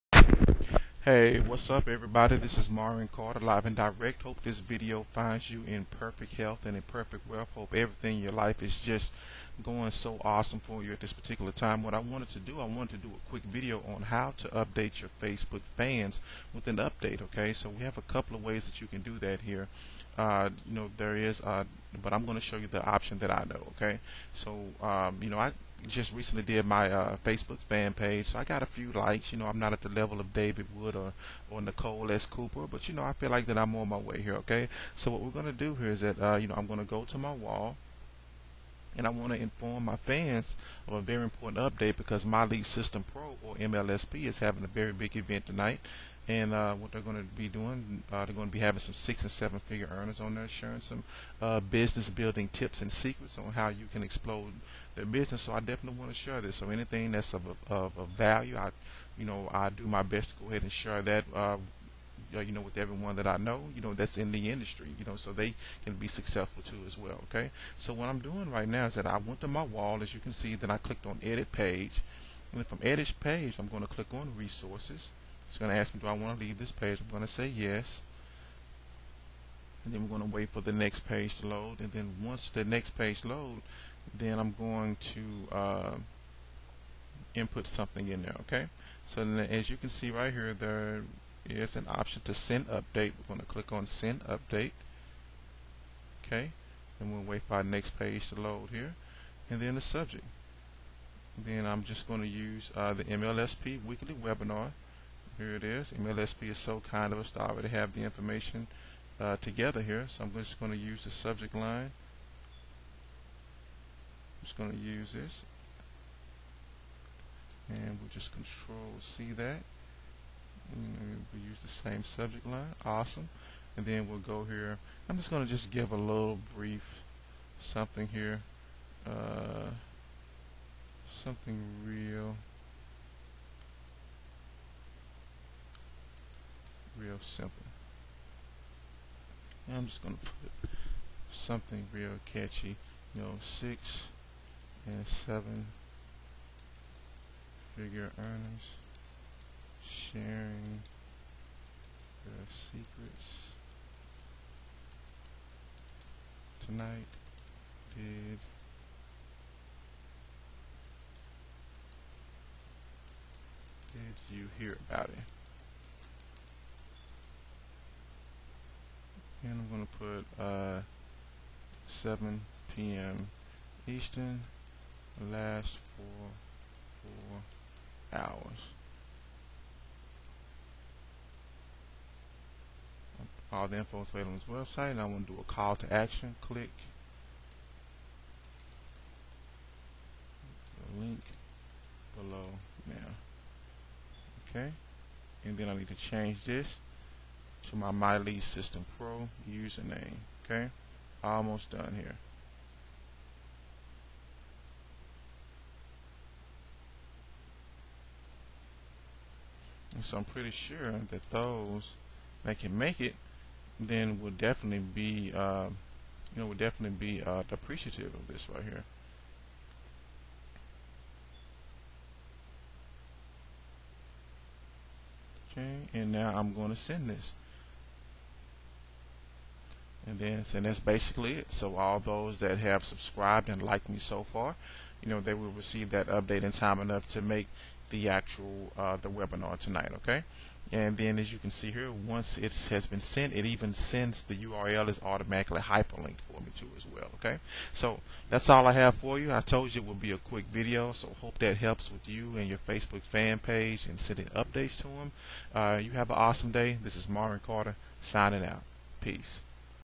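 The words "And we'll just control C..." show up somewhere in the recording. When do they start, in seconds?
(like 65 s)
117 s.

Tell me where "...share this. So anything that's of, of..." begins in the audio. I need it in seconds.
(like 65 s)
56 s.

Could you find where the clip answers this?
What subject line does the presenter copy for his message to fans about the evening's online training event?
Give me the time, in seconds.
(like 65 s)
103 s.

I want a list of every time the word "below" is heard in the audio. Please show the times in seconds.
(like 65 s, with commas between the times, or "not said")
192 s.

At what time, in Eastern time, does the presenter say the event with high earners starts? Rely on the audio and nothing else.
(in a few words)
7 p.m.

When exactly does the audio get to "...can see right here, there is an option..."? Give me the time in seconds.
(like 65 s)
89 s.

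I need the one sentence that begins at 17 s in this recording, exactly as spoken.
So we have a couple of ways that you can do that here.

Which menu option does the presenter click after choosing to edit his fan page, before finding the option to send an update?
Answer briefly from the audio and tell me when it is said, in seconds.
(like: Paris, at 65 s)
resources, at 74 s.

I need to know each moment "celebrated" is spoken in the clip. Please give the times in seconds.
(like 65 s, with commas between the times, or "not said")
not said.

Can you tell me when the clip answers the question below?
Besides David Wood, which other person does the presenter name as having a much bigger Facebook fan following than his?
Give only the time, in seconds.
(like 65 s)
31 s.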